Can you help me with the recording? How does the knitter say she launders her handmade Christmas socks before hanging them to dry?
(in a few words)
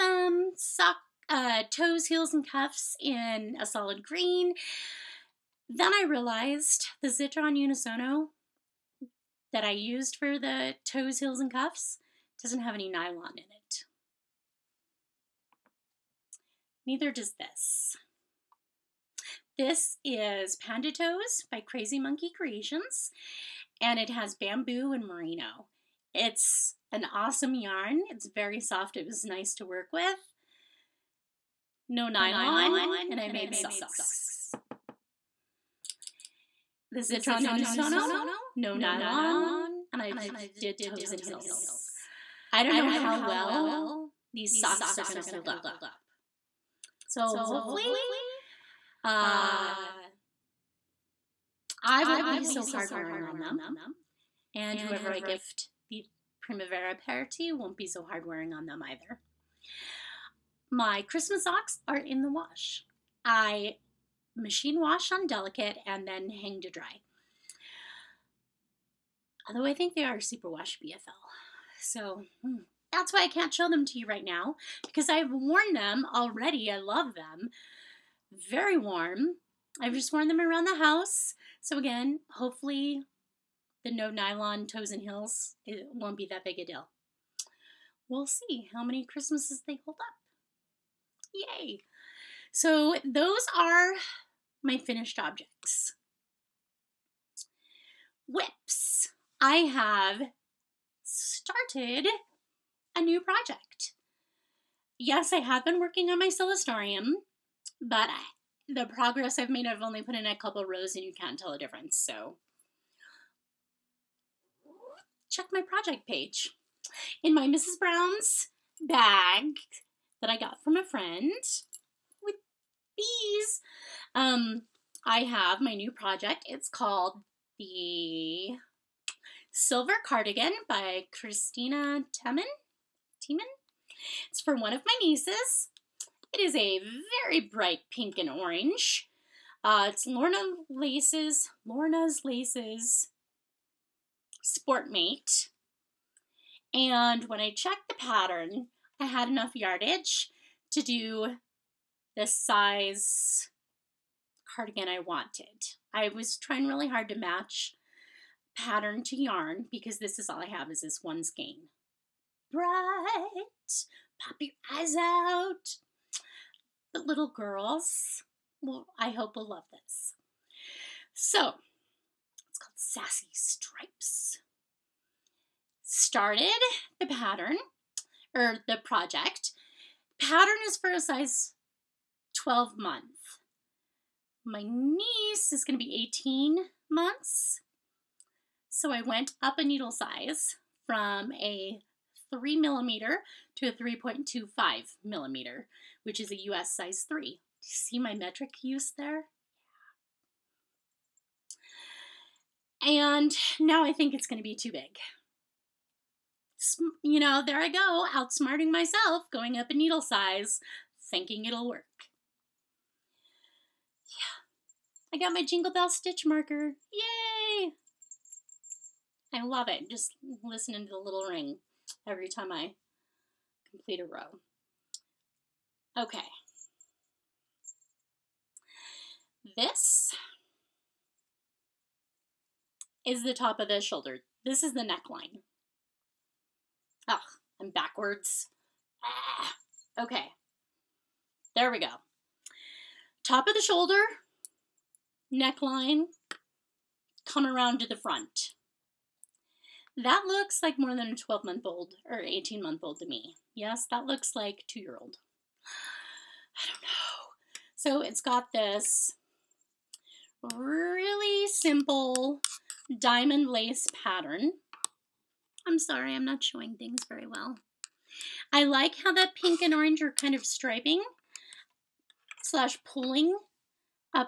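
Machine wash on delicate.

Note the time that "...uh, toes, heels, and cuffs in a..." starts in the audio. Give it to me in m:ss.
0:01.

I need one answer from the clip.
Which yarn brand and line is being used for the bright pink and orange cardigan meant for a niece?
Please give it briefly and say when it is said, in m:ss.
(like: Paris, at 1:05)
Lorna's Laces Sportmate, at 2:21.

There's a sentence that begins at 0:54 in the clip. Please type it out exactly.
And whoever I gift the Primavera party won't be so hard wearing on them either.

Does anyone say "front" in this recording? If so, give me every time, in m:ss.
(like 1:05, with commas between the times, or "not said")
4:07.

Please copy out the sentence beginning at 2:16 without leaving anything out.
It is a very bright pink and orange.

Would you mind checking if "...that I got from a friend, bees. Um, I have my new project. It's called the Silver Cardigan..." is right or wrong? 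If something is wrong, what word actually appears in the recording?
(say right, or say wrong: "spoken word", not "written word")
right.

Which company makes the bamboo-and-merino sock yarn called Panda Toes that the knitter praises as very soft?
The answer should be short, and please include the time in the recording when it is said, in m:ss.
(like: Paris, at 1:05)
Crazy Monkey Creations, at 0:21.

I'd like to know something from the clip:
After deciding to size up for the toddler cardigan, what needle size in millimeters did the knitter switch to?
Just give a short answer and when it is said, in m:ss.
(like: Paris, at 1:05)
3.25 millimeters, at 3:13.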